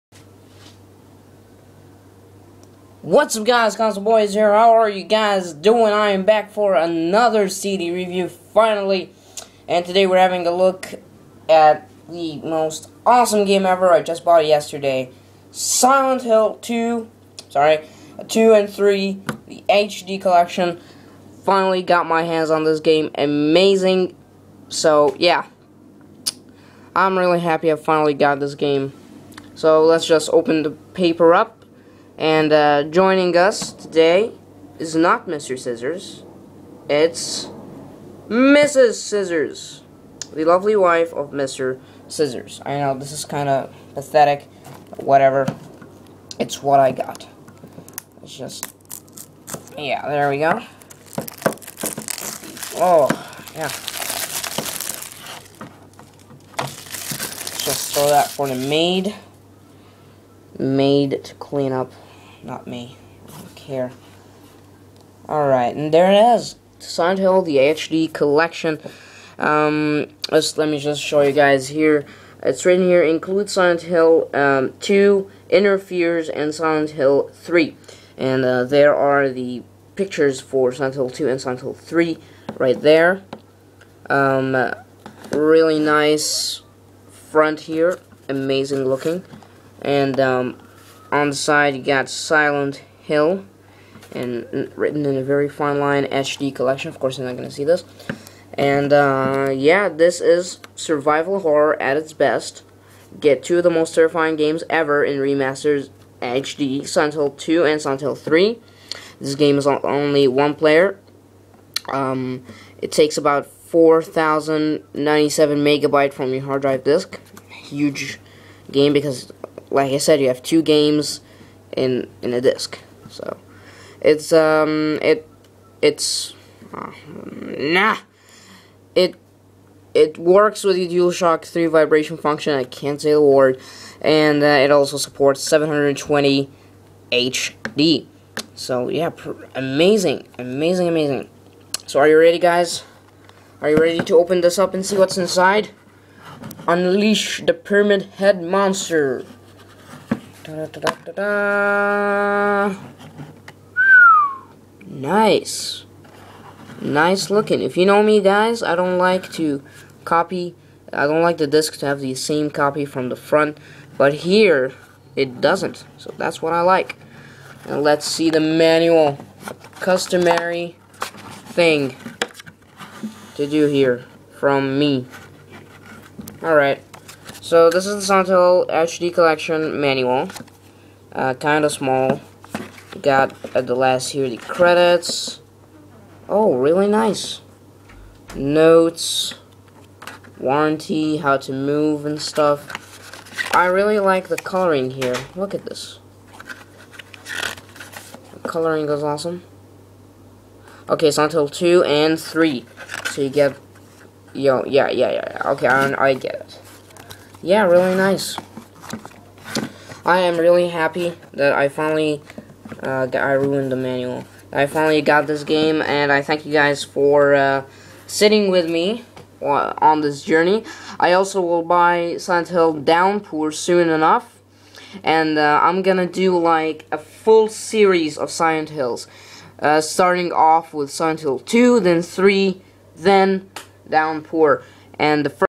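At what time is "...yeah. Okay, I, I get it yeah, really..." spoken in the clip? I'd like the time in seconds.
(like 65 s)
205 s.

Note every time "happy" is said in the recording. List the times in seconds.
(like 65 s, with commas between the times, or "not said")
27 s, 210 s.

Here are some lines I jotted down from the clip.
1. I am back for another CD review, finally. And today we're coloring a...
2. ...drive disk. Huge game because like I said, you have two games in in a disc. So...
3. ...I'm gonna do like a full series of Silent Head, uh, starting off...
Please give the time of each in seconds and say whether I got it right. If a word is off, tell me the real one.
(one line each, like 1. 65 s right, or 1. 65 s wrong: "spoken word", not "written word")
1. 5 s wrong: "having", not "coloring"
2. 116 s right
3. 225 s wrong: "Hills", not "Head".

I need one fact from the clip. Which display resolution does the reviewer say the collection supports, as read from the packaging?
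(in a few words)
720.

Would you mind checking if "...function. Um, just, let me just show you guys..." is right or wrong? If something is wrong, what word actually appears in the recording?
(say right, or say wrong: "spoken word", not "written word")
wrong: "collection", not "function".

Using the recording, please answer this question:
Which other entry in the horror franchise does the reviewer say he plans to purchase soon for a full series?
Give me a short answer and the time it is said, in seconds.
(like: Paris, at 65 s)
Silent Hill Downpour, at 222 s.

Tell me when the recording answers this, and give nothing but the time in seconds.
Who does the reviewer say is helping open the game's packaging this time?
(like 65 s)
38 s.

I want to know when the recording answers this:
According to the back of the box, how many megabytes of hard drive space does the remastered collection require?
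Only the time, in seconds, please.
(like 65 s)
113 s.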